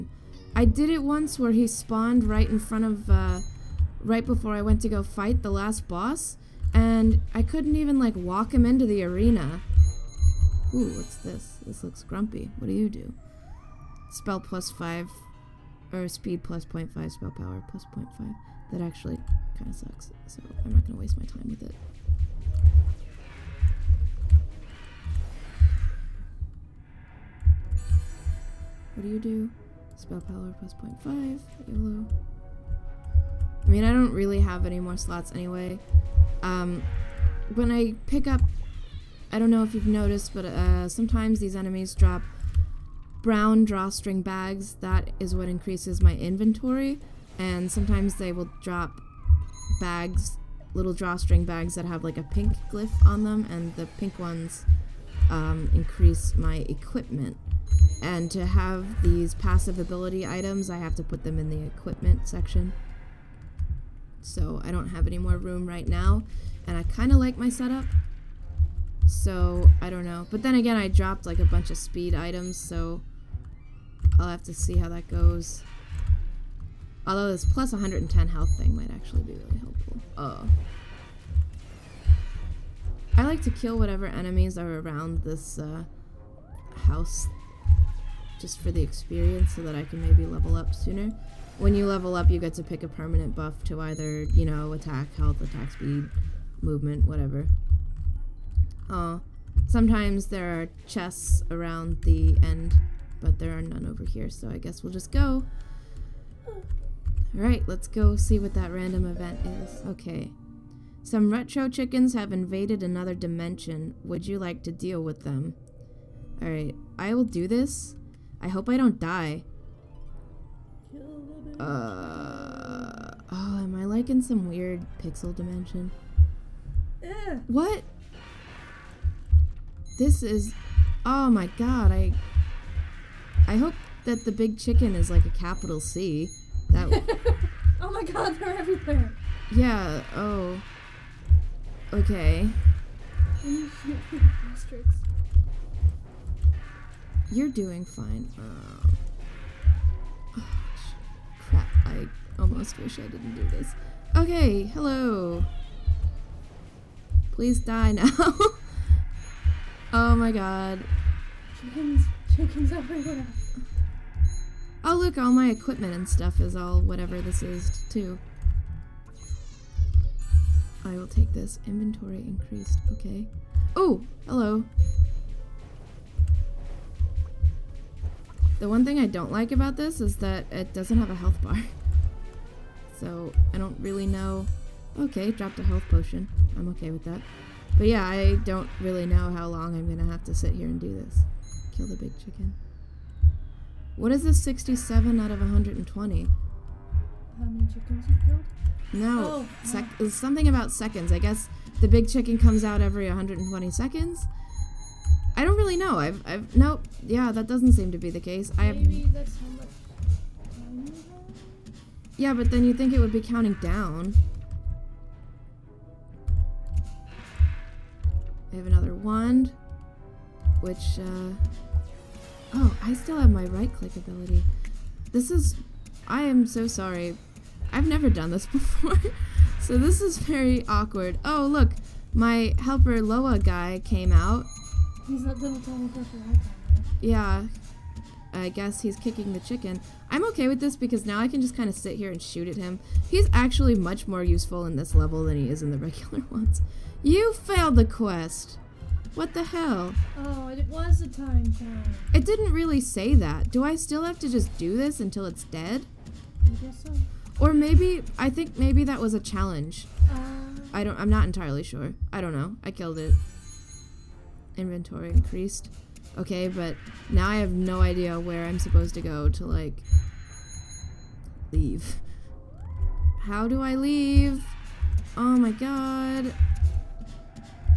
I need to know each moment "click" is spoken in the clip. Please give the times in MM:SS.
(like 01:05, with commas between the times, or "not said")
03:43.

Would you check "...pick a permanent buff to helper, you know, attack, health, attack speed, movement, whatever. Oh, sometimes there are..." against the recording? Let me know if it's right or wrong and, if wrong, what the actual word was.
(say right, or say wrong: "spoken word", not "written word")
wrong: "either", not "helper".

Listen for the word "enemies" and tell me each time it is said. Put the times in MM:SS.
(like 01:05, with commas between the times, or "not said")
00:41, 01:24.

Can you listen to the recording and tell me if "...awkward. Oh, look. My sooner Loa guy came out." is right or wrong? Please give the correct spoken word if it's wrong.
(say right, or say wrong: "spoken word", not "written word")
wrong: "helper", not "sooner".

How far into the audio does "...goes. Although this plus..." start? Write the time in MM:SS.
01:15.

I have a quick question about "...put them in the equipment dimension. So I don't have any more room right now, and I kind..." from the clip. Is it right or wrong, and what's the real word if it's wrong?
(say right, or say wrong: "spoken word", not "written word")
wrong: "section", not "dimension".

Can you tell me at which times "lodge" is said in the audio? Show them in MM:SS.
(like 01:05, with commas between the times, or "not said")
not said.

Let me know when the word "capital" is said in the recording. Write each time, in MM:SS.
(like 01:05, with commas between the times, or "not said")
02:15.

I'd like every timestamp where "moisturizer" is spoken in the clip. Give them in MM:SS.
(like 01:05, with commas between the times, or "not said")
not said.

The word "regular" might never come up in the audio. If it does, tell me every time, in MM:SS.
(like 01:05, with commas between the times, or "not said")
04:05.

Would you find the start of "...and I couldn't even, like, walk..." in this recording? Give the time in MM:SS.
00:06.